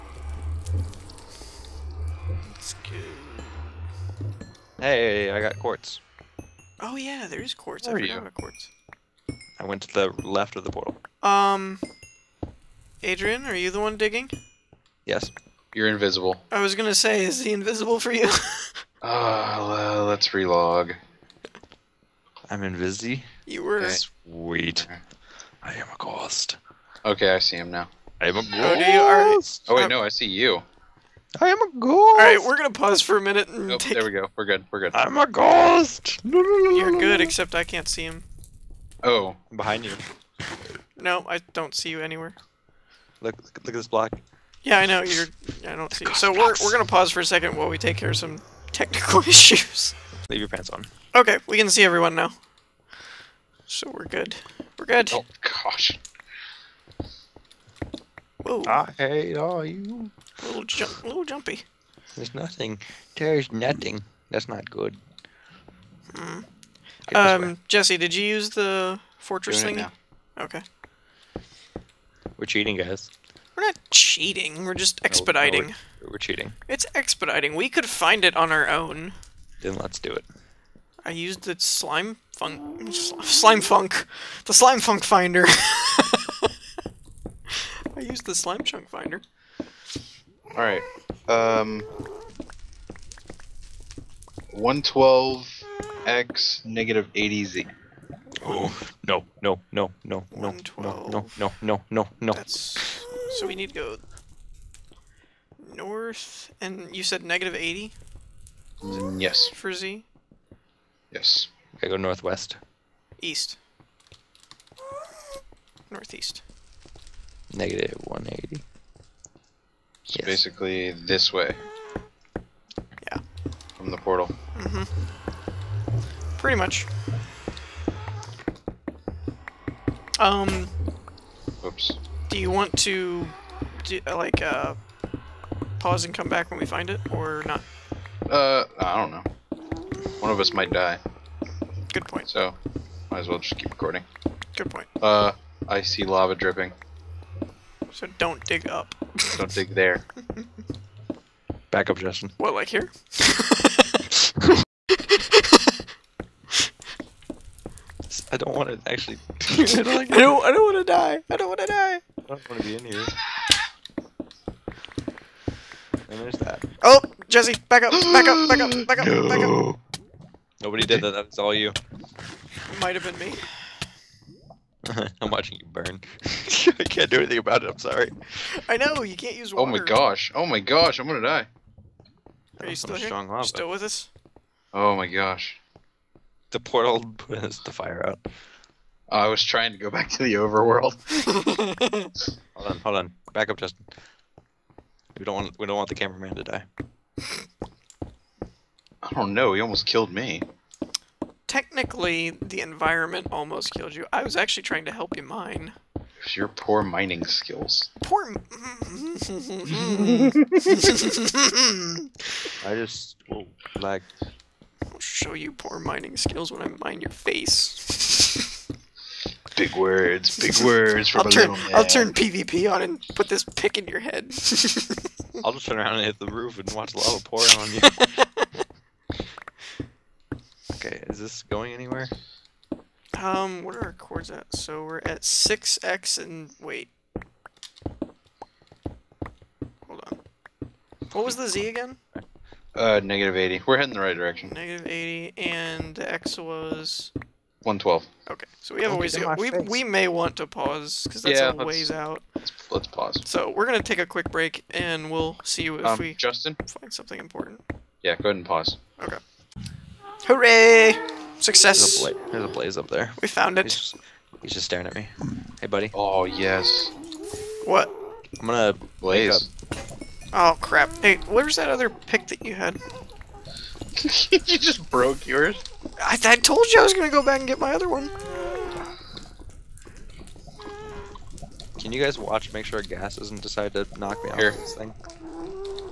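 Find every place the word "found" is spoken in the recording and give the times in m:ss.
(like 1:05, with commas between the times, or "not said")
4:23.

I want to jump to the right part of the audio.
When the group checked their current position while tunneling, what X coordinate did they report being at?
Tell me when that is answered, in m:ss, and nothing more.
3:55.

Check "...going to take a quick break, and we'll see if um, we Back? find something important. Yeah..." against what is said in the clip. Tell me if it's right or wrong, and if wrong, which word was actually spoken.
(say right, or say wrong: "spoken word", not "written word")
wrong: "Justin", not "Back".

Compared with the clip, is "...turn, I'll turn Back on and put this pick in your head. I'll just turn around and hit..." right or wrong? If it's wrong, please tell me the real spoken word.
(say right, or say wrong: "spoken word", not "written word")
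wrong: "PvP", not "Back".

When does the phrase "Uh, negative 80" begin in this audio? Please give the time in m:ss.
4:02.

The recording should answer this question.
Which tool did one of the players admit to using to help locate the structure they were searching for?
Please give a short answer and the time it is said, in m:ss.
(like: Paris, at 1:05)
Slime chunk finder, at 1:28.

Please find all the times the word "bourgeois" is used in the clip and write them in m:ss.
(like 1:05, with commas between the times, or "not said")
not said.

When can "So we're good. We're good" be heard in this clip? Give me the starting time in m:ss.
0:53.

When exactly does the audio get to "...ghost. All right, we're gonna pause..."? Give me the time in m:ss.
0:31.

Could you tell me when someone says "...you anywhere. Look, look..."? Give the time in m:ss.
0:41.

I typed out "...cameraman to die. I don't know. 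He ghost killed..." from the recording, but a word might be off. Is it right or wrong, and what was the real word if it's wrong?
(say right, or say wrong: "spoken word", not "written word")
wrong: "almost", not "ghost".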